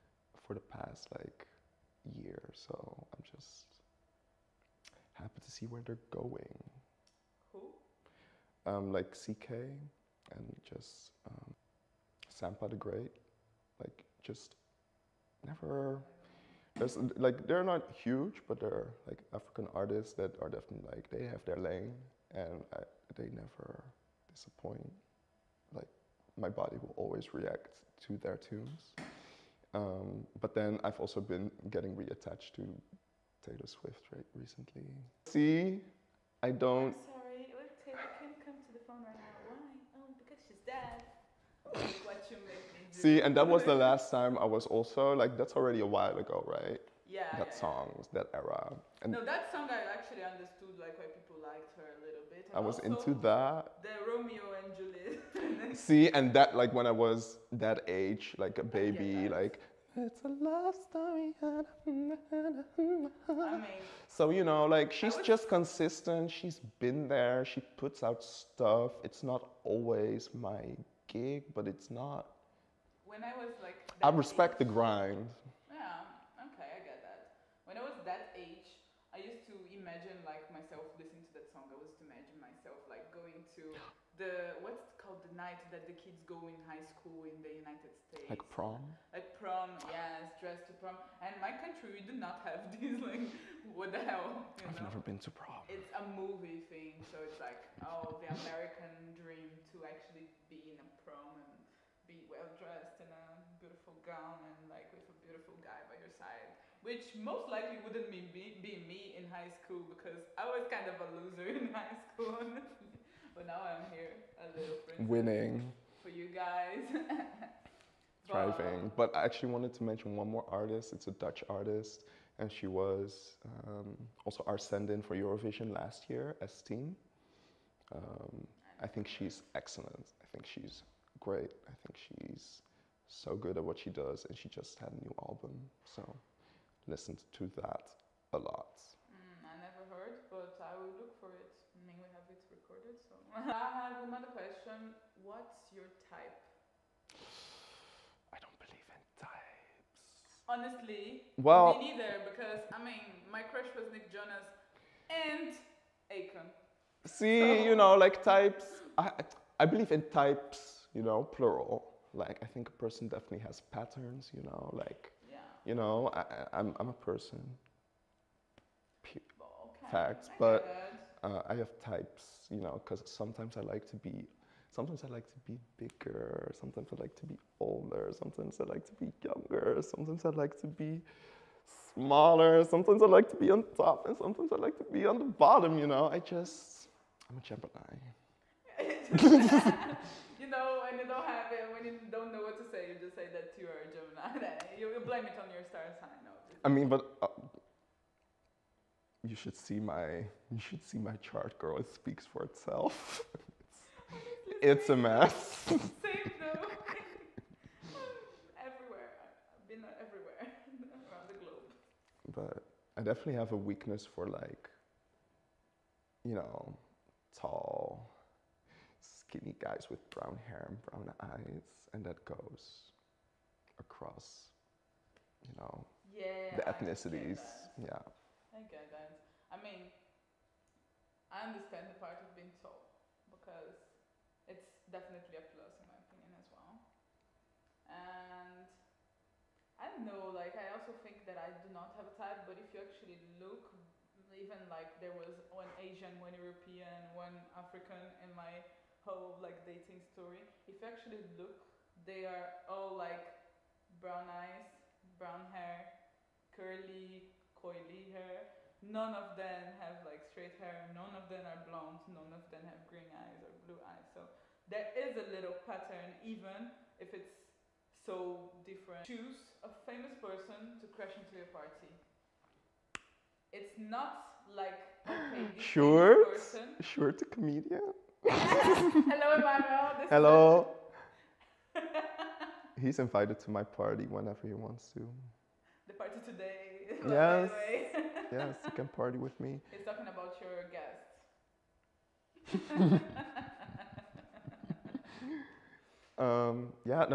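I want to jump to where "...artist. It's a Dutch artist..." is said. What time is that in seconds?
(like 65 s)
120 s.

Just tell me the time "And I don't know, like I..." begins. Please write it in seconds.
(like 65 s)
237 s.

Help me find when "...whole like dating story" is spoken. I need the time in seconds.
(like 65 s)
249 s.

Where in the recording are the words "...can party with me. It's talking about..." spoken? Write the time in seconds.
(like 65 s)
288 s.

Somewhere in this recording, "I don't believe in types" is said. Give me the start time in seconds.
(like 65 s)
148 s.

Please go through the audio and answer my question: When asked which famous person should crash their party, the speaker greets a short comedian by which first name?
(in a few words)
Emmanuel.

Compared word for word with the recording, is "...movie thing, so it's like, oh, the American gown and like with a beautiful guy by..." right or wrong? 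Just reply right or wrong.
right.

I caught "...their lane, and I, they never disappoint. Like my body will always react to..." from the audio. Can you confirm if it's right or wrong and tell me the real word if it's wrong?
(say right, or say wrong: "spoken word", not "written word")
right.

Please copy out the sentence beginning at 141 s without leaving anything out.
I mean, we have it recorded, so.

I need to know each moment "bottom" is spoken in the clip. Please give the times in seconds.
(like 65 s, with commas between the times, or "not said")
185 s.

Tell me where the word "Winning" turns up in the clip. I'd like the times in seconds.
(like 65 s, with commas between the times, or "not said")
115 s.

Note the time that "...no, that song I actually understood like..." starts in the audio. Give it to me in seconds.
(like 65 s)
49 s.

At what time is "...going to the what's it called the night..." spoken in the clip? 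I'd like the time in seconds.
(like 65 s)
83 s.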